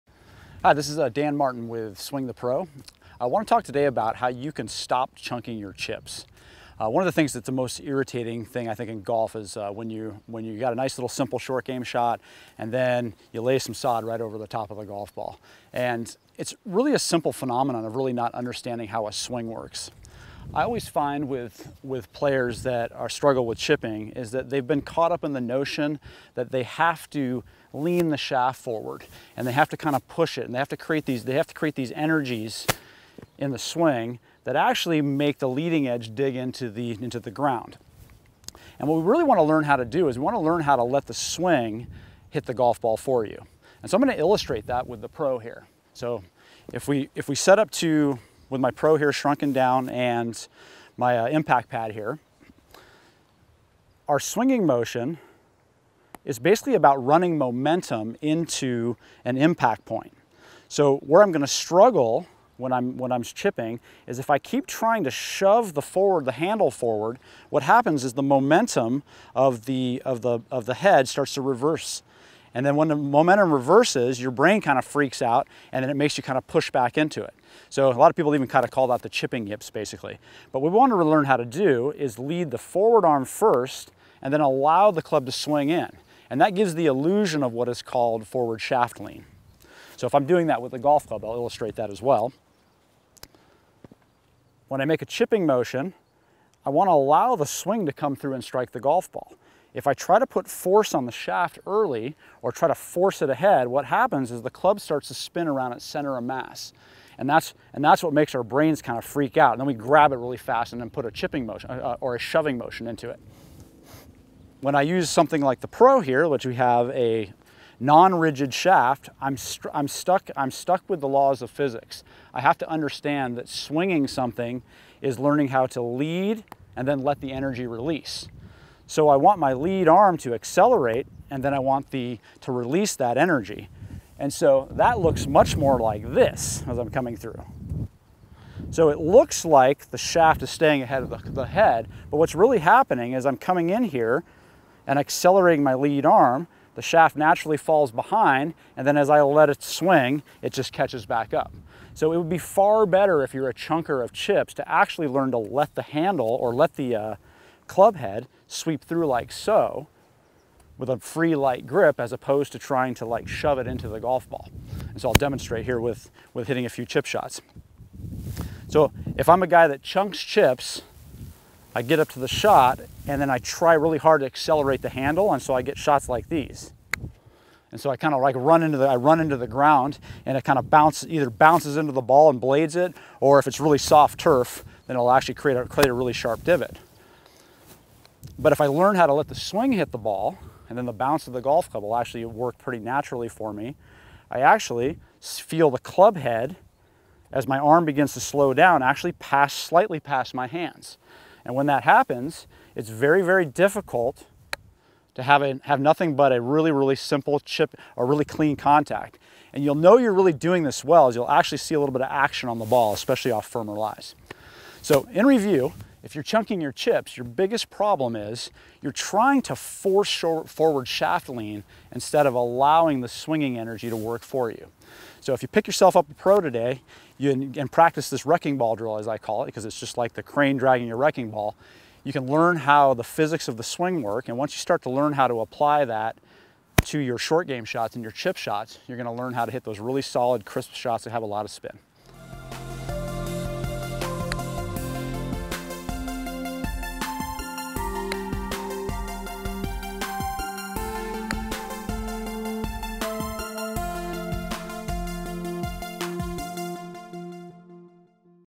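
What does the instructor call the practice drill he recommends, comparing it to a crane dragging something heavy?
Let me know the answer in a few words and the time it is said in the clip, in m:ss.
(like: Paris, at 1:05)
wrecking ball drill, at 3:48.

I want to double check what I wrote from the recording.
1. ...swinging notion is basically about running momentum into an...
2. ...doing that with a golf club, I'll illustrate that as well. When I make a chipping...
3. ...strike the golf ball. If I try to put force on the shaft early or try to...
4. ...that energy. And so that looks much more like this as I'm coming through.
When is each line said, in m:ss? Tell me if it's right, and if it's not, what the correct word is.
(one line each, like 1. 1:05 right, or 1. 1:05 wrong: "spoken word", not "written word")
1. 0:54 wrong: "motion", not "notion"
2. 1:30 right
3. 1:38 right
4. 2:12 right.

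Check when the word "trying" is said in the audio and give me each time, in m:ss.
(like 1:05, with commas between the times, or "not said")
1:04, 2:42, 3:38.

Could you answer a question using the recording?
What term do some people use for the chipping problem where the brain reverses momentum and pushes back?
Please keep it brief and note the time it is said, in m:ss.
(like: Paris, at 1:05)
chipping yips, at 1:19.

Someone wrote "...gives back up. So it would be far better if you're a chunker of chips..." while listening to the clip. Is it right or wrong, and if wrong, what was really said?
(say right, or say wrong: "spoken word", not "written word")
wrong: "catches", not "gives".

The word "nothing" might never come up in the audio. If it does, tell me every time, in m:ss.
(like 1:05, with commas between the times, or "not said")
3:25.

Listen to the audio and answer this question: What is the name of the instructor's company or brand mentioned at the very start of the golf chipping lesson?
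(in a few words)
Swing the Pro.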